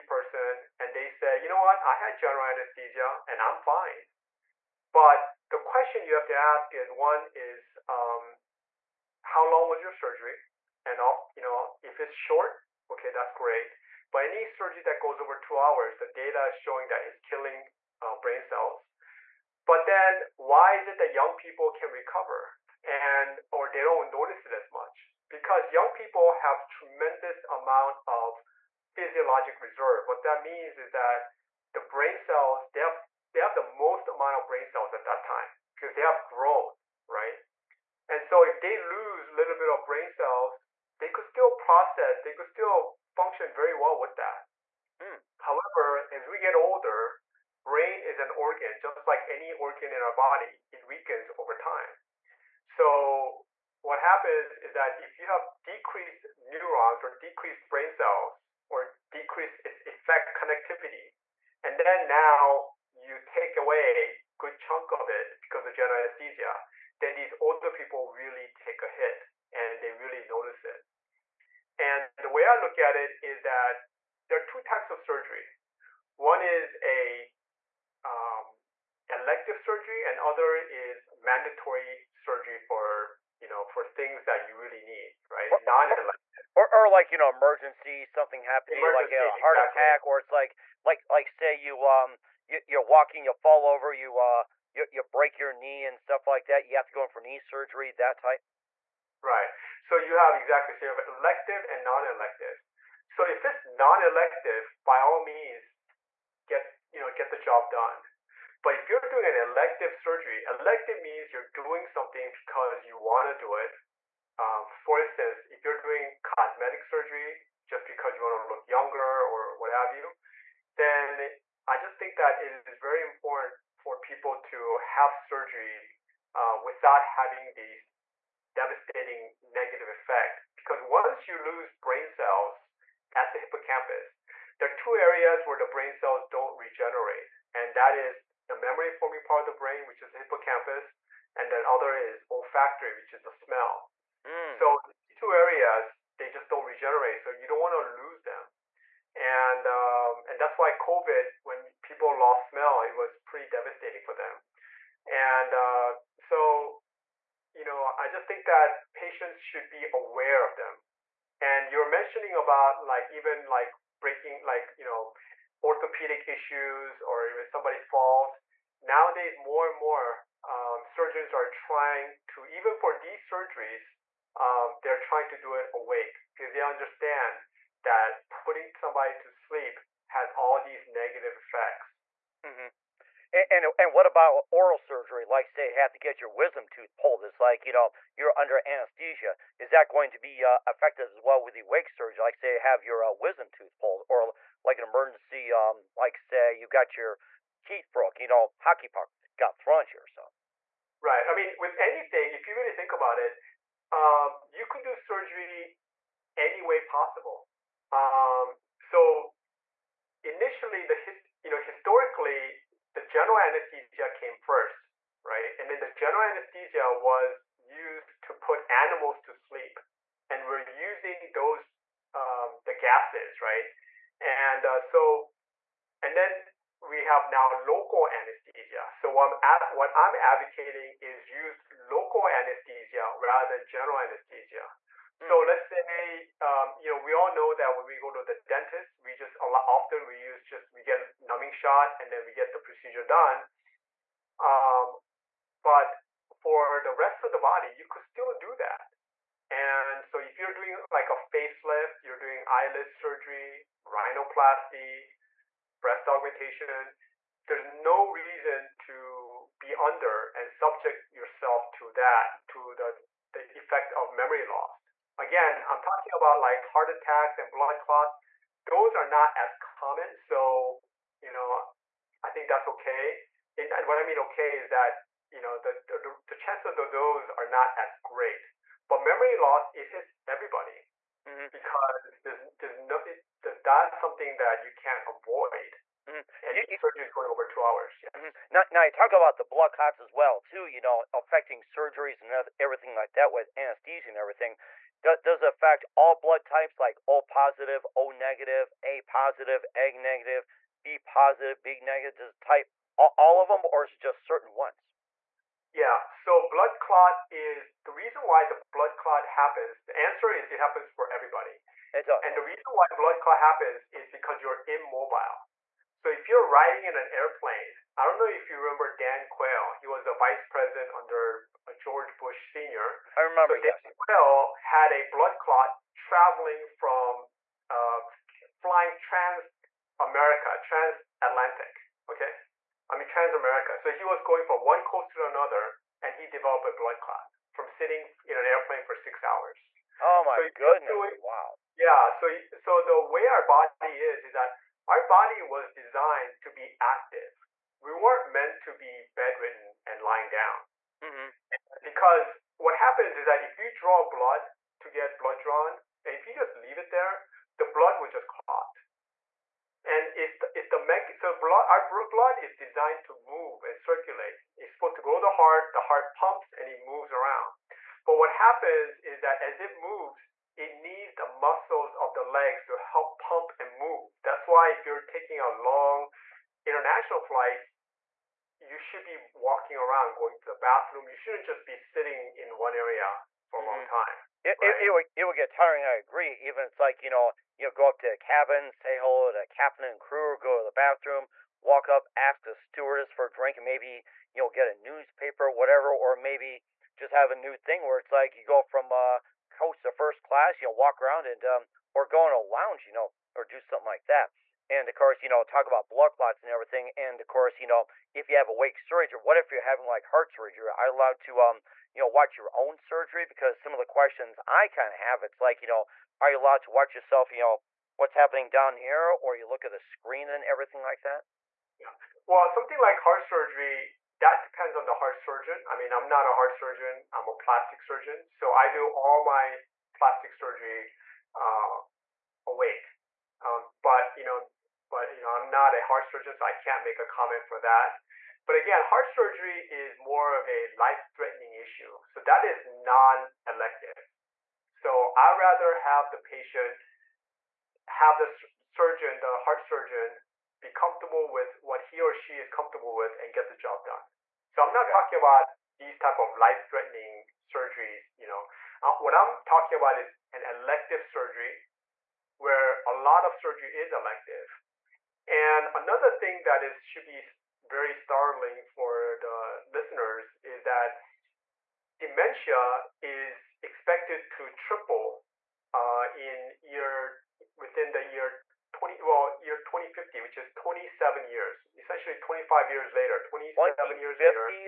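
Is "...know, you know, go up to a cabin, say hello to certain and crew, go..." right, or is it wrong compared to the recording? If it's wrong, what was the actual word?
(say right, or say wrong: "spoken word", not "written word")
wrong: "captain", not "certain".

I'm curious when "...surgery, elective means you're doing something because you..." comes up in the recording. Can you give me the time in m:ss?
1:50.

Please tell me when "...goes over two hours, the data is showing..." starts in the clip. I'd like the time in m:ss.
0:14.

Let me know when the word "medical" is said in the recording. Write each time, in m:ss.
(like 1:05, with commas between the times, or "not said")
not said.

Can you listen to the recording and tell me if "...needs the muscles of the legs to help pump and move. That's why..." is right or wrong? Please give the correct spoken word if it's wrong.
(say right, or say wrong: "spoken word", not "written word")
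right.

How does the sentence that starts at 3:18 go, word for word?
You know, hockey puck got thrown at you or something.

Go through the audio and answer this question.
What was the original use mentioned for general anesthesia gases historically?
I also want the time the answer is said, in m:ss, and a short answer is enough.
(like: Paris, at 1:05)
Put animals to sleep, at 3:38.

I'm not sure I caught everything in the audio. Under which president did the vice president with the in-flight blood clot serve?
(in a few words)
George Bush Sr.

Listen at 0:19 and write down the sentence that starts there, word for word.
But then why is it that young people can recover and or they don't notice it as much?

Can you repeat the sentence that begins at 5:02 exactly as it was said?
Does it type all, all of them or is it just certain ones?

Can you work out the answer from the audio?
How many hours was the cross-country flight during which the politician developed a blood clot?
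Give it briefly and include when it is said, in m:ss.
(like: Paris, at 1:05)
6, at 5:38.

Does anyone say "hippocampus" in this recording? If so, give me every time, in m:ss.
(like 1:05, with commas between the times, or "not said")
2:13, 2:20.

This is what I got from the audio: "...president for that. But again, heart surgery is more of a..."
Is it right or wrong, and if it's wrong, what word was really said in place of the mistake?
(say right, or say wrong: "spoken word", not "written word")
wrong: "comment", not "president".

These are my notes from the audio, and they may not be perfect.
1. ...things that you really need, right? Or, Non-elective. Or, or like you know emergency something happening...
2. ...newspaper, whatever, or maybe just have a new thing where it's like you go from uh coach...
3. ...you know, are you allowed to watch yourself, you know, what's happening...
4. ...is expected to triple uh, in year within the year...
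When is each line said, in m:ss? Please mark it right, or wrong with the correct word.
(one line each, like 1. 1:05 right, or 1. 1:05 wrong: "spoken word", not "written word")
1. 1:23 right
2. 6:34 right
3. 6:55 right
4. 7:52 right.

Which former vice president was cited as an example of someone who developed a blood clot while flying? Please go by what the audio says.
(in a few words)
Dan Quayle.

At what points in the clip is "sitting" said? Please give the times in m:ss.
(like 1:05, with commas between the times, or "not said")
5:37, 6:21.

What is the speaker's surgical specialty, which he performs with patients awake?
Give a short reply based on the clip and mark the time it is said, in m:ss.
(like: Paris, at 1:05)
Plastic surgeon, at 7:07.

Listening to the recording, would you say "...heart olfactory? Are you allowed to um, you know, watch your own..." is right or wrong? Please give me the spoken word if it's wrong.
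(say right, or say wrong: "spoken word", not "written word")
wrong: "surgery", not "olfactory".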